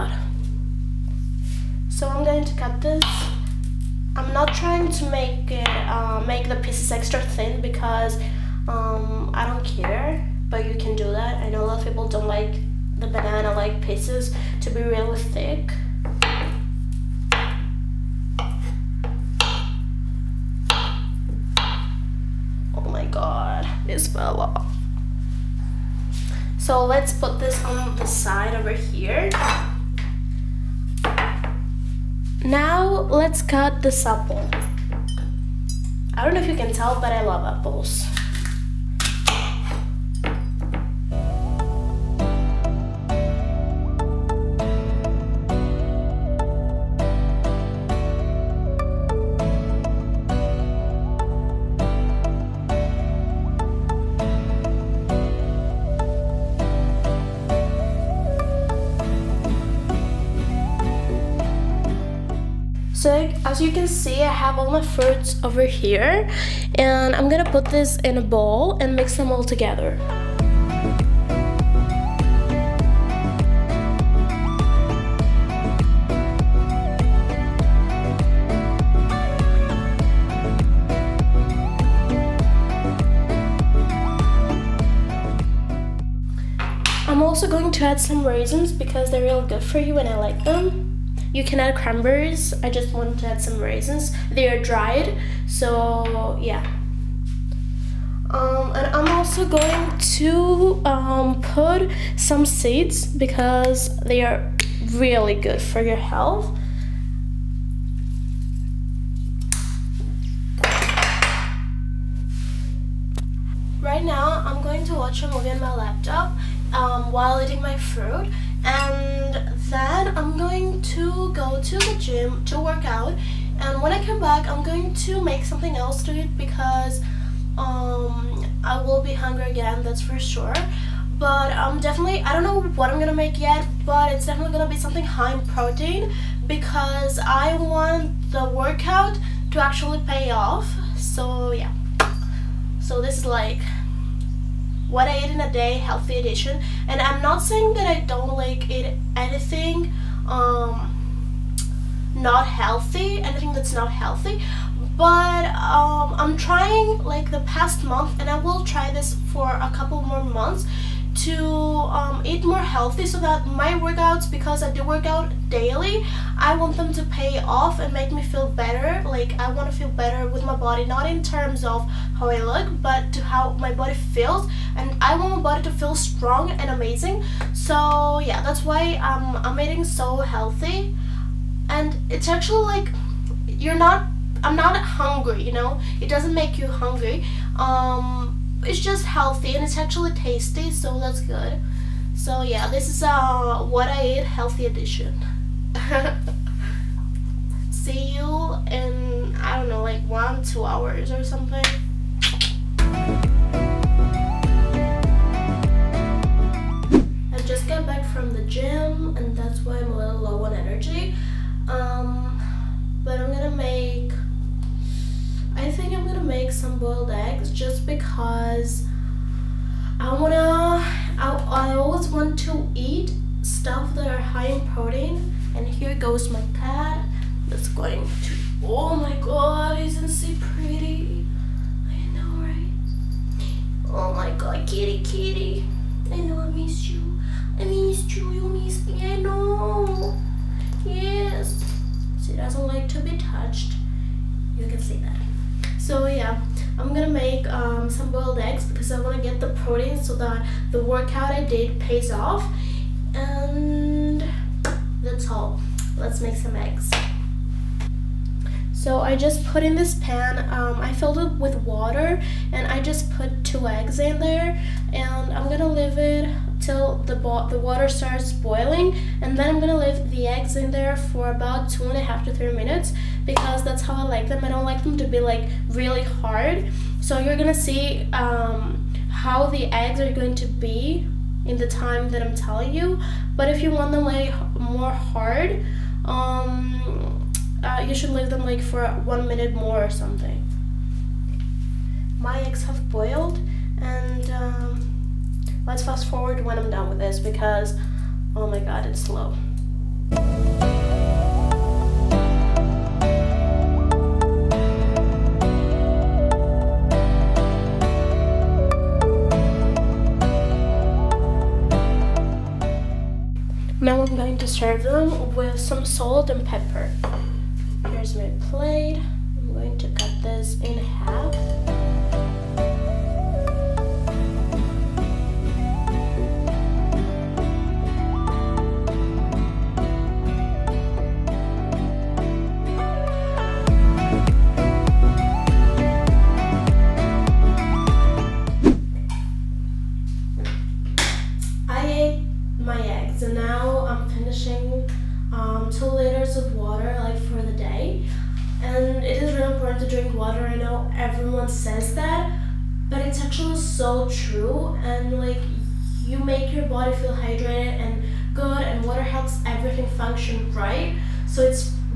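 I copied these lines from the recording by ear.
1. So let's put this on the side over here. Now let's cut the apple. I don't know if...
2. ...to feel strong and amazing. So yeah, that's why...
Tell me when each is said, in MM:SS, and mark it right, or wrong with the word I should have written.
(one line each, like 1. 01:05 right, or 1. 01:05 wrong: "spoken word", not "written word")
1. 00:26 right
2. 02:55 right.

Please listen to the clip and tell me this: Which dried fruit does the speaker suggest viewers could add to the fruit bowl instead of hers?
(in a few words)
Cranberries.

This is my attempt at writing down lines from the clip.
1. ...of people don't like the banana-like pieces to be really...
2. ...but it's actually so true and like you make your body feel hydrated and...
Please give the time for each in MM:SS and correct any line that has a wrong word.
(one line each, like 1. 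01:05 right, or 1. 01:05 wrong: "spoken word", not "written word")
1. 00:11 right
2. 05:52 right.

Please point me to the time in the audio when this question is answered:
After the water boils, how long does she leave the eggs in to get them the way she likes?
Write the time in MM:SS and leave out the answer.
04:31.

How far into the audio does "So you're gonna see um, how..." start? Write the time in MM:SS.
04:36.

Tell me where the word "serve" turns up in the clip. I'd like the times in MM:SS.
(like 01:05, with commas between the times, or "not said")
05:14.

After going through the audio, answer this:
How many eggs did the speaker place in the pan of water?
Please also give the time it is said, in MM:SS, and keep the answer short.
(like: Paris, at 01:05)
2, at 04:23.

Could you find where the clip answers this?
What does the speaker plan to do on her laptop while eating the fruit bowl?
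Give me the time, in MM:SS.
01:54.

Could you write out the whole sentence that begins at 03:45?
And here goes my cat that's going to, oh my god, isn't she pretty?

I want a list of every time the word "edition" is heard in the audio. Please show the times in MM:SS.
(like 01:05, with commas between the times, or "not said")
02:26, 03:14.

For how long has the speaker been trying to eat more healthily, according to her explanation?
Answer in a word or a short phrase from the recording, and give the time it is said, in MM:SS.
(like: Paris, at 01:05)
The past month, at 02:37.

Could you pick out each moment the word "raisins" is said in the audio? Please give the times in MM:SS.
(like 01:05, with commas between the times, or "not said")
01:28, 01:33.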